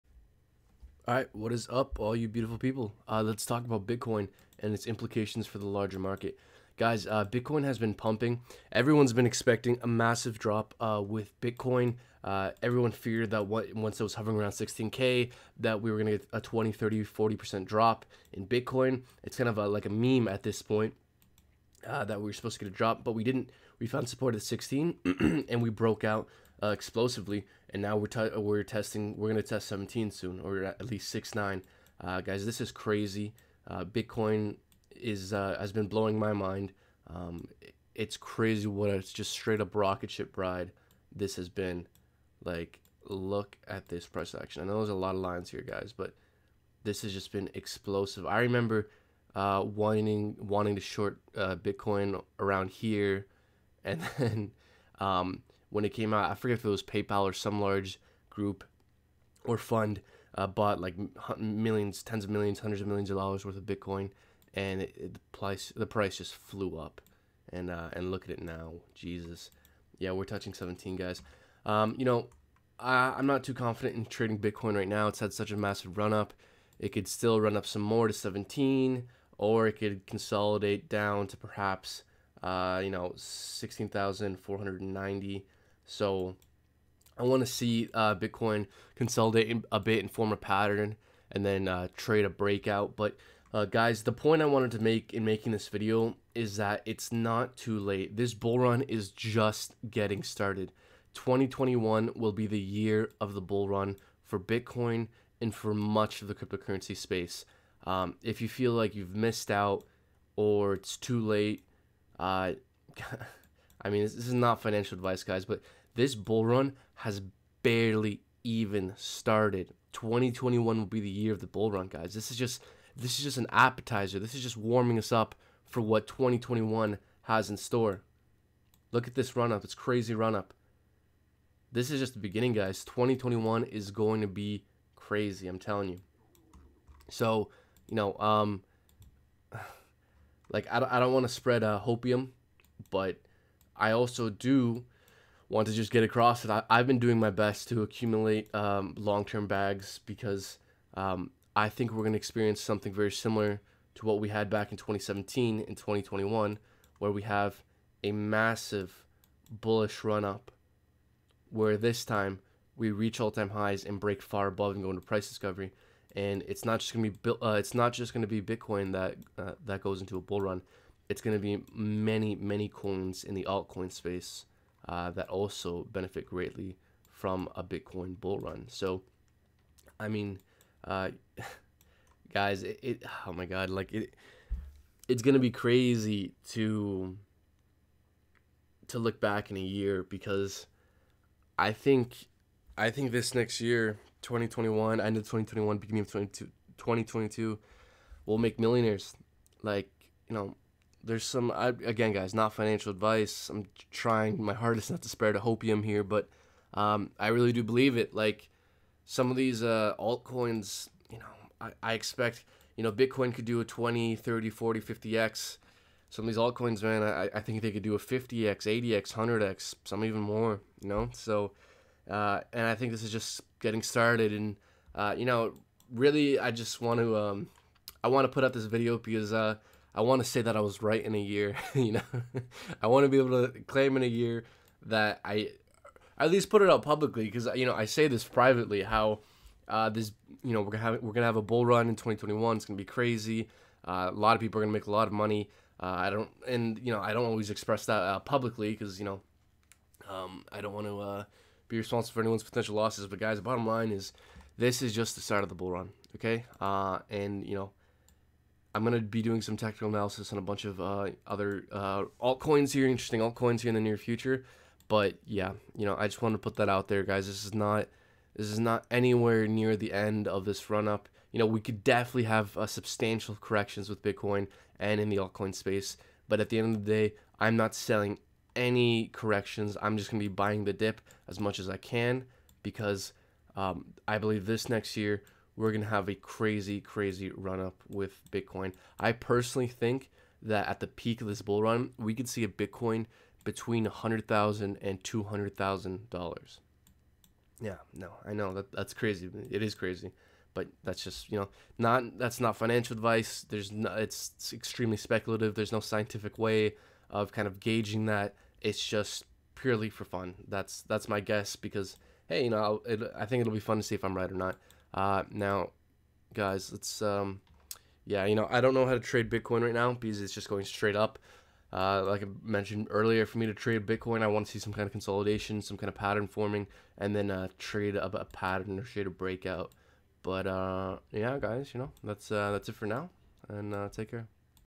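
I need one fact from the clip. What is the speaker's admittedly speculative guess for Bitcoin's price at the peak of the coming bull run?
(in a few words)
$100,000 to $200,000.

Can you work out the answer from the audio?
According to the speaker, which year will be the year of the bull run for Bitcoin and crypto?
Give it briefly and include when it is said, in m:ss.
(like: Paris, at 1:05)
2021, at 1:41.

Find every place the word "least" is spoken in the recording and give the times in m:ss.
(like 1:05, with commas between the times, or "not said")
0:30, 3:56.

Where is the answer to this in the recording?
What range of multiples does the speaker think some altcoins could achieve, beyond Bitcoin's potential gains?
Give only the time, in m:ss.
3:37.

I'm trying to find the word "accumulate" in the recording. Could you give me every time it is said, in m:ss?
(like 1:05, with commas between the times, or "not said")
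2:27.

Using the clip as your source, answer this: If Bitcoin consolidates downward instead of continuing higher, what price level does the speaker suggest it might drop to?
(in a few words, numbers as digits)
16,490.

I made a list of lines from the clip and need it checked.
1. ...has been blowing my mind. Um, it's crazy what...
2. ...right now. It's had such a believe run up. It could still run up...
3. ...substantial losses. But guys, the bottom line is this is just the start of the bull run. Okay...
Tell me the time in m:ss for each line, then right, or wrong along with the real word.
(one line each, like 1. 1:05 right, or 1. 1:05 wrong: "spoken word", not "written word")
1. 0:35 right
2. 1:14 wrong: "massive", not "believe"
3. 4:12 wrong: "potential", not "substantial".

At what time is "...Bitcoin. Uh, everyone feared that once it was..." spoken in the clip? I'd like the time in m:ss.
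0:11.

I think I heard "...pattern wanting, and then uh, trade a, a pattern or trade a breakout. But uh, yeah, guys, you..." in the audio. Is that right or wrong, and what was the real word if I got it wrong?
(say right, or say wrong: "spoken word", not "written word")
wrong: "forming", not "wanting".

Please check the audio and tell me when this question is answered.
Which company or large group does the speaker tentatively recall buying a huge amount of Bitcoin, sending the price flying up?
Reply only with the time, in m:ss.
0:56.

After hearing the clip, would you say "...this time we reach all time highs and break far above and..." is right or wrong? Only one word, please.
right.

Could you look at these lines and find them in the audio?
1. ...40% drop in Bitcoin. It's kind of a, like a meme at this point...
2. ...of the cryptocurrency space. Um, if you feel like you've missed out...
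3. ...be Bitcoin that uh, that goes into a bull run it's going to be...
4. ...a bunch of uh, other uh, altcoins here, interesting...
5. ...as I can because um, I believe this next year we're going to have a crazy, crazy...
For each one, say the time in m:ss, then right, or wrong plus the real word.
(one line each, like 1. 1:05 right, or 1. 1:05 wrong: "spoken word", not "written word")
1. 0:17 right
2. 1:46 right
3. 2:48 right
4. 4:20 right
5. 4:41 right.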